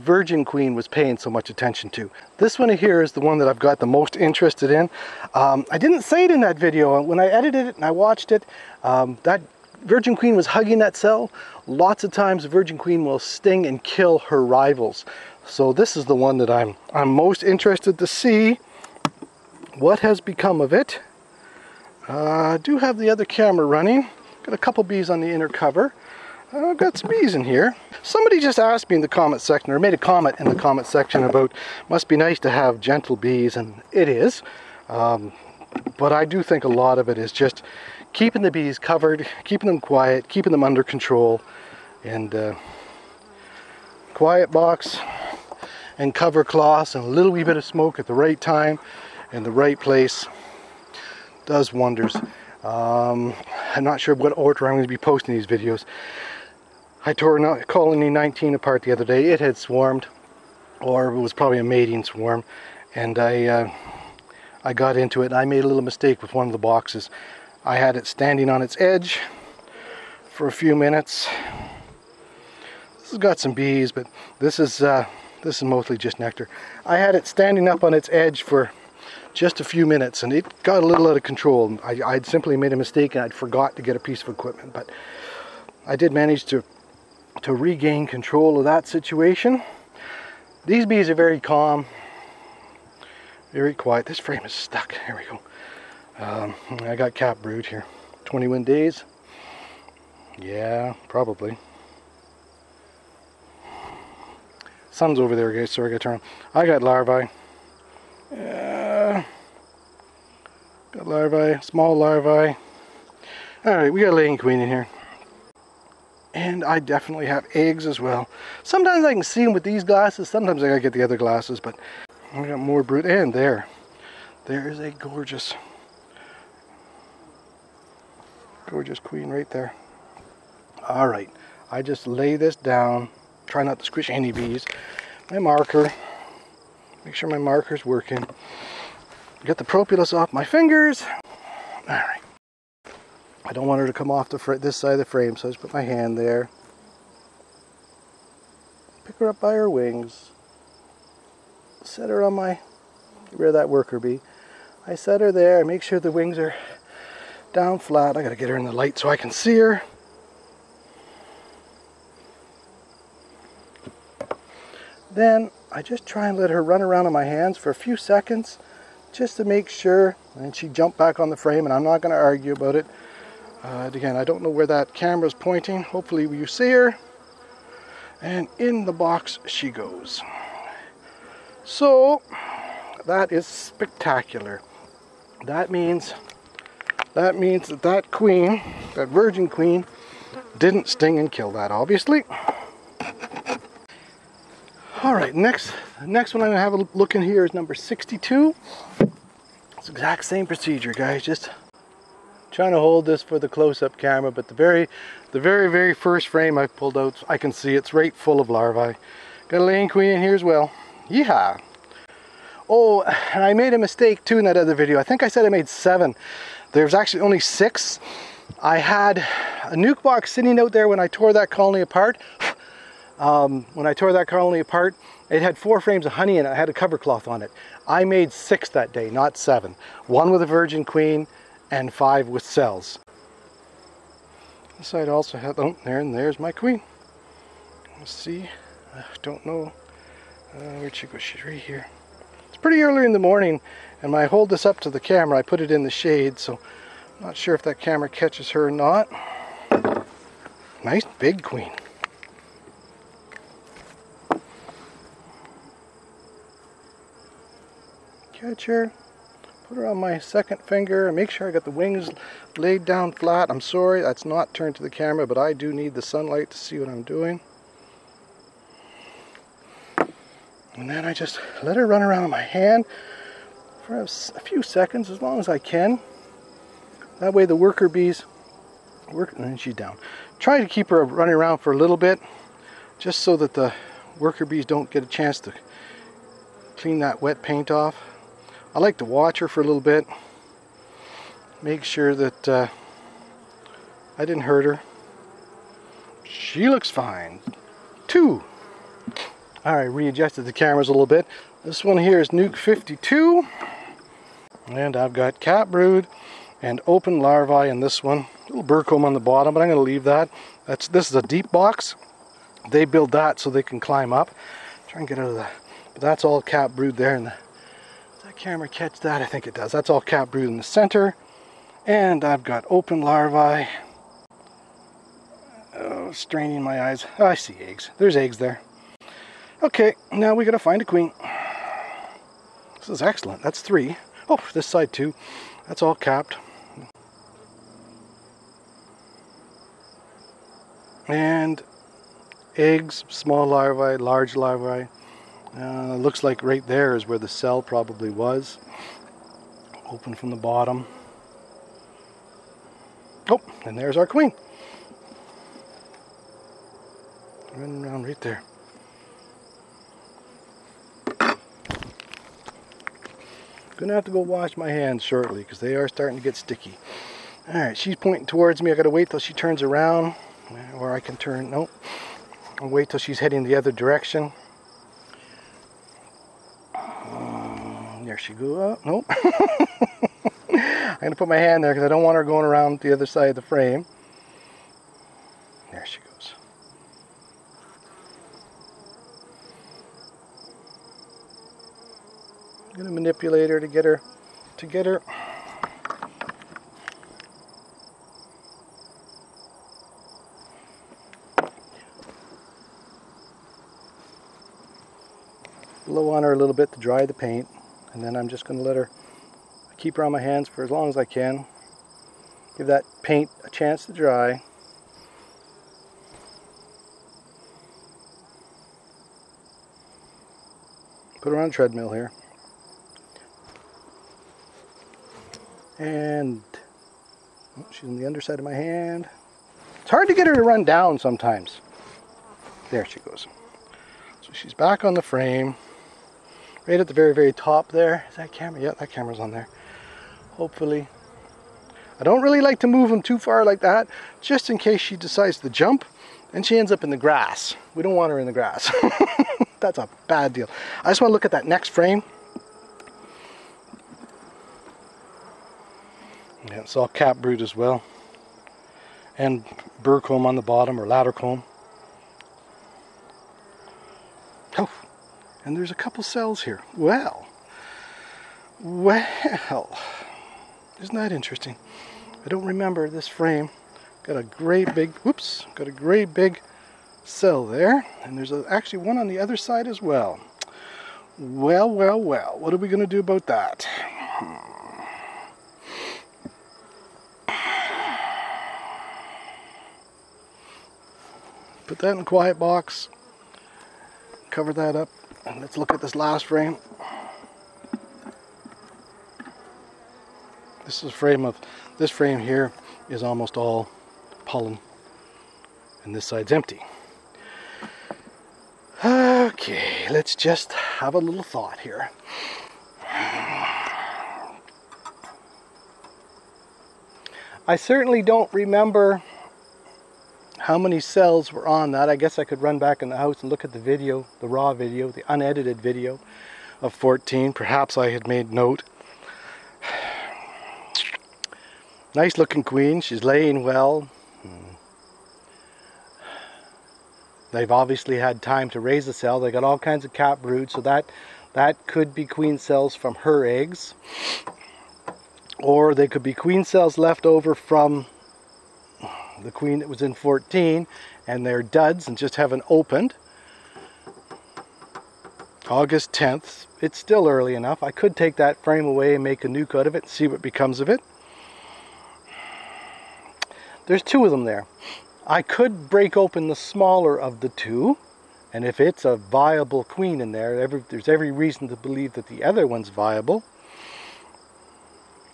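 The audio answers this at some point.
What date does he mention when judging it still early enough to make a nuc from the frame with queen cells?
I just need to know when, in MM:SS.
09:15.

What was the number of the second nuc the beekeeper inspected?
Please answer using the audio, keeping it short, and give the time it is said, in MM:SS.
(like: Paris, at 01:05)
62, at 03:17.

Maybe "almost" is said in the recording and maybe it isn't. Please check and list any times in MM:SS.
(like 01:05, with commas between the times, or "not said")
08:23.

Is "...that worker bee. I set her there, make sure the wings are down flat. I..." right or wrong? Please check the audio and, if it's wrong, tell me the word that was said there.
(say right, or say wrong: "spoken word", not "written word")
right.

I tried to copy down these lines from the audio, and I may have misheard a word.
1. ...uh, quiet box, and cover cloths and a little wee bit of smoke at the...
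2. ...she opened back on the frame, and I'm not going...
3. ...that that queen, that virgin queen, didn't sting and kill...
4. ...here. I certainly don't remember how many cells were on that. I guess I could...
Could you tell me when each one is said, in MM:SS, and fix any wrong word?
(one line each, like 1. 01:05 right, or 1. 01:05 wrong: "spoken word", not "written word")
1. 00:42 right
2. 02:50 wrong: "jumped", not "opened"
3. 03:07 right
4. 08:31 right.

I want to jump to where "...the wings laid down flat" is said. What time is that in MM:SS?
04:21.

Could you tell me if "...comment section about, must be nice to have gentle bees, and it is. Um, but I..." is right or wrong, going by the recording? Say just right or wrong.
right.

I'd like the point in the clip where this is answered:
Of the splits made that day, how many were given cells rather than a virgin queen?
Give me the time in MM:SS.
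03:51.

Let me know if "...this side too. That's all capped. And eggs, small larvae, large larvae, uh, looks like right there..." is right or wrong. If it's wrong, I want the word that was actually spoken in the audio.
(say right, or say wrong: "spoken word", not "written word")
right.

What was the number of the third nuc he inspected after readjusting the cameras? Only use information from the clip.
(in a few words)
52.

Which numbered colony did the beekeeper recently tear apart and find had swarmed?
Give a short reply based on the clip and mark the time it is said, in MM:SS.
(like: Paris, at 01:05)
19, at 00:57.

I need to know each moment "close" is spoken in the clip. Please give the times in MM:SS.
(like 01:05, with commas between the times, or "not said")
03:23.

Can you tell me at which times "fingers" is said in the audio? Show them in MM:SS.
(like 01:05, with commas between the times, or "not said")
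02:20, 04:20.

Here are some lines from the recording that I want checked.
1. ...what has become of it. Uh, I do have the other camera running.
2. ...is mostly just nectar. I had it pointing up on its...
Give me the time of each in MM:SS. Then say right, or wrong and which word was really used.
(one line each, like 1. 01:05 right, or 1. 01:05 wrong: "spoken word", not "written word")
1. 00:19 right
2. 01:15 wrong: "standing", not "pointing".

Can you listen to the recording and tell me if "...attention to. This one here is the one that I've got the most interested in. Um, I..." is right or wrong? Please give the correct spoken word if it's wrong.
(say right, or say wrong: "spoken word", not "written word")
right.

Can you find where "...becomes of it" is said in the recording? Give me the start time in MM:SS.
09:20.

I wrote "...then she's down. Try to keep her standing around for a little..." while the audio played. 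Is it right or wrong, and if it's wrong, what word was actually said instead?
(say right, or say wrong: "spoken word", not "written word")
wrong: "running", not "standing".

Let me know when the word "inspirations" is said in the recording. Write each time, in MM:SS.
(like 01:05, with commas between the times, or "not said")
not said.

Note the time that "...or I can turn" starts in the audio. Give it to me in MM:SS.
06:10.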